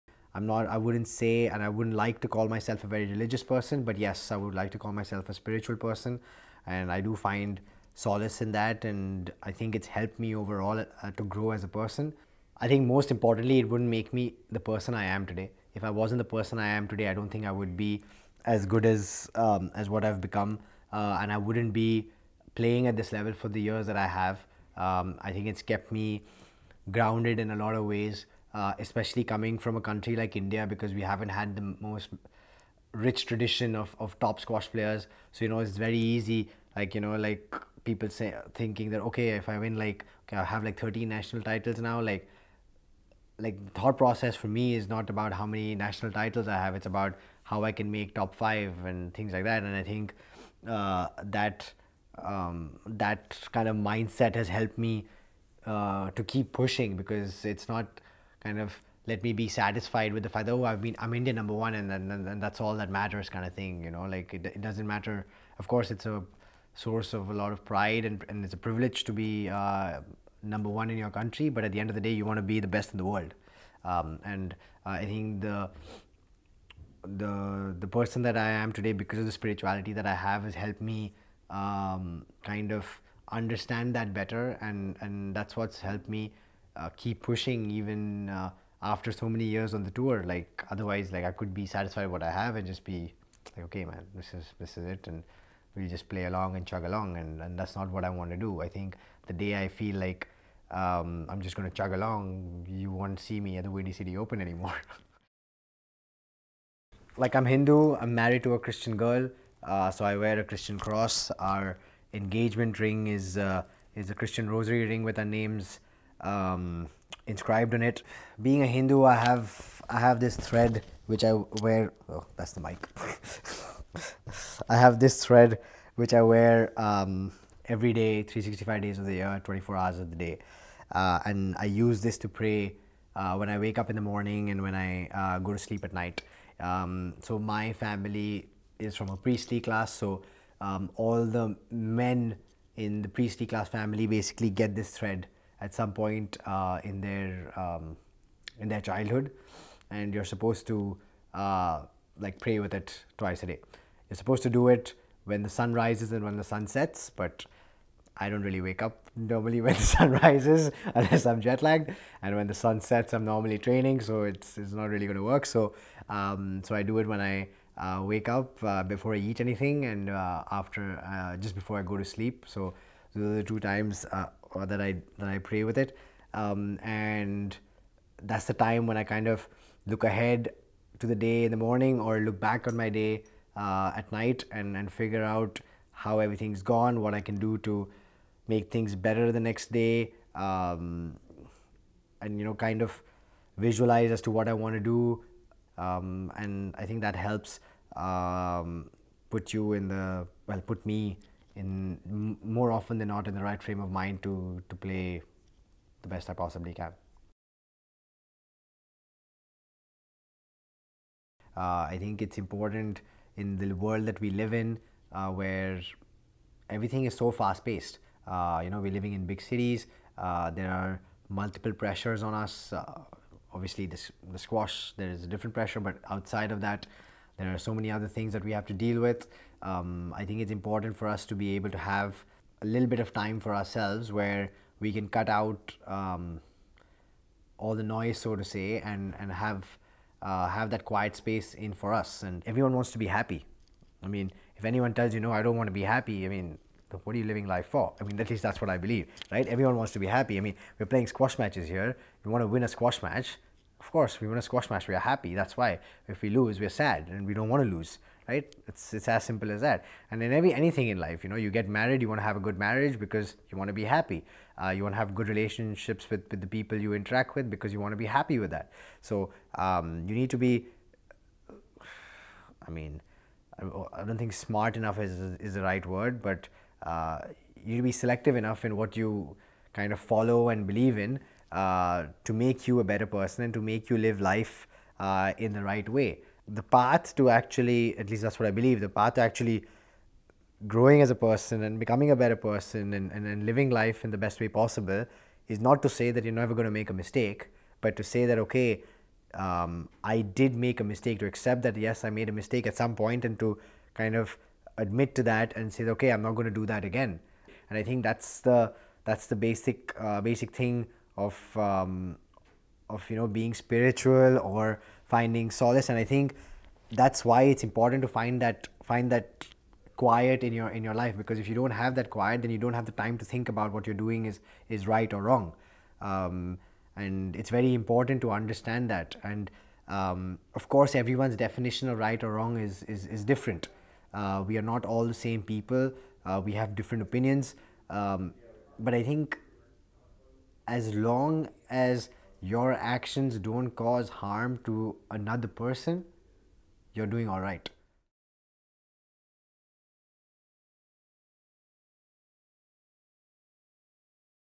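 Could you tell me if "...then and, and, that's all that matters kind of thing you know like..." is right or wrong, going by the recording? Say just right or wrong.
right.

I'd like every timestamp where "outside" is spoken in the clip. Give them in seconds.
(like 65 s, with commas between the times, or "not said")
226 s.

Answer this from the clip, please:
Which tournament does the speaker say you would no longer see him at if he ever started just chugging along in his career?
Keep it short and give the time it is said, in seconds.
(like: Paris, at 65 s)
Windy City Open, at 103 s.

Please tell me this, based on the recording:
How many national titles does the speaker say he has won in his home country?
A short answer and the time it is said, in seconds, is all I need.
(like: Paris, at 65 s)
13, at 40 s.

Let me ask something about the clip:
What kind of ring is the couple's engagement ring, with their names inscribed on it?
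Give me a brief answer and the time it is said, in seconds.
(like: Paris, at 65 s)
Christian rosary ring, at 114 s.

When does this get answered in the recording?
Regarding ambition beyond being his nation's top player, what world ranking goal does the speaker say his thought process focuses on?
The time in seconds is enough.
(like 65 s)
48 s.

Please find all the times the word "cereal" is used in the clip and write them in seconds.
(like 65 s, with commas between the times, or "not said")
not said.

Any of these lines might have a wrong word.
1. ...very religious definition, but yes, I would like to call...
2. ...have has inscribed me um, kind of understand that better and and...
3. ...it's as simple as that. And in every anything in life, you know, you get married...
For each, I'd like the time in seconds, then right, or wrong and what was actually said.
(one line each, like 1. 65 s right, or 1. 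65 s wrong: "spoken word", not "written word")
1. 2 s wrong: "person", not "definition"
2. 80 s wrong: "helped", not "inscribed"
3. 258 s right.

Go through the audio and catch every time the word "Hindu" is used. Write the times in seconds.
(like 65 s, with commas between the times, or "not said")
107 s, 118 s.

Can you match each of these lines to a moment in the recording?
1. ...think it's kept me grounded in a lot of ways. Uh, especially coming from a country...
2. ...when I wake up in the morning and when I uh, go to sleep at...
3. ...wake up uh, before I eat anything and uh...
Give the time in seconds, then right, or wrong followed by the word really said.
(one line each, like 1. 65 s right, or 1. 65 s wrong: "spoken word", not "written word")
1. 25 s right
2. 133 s right
3. 168 s right.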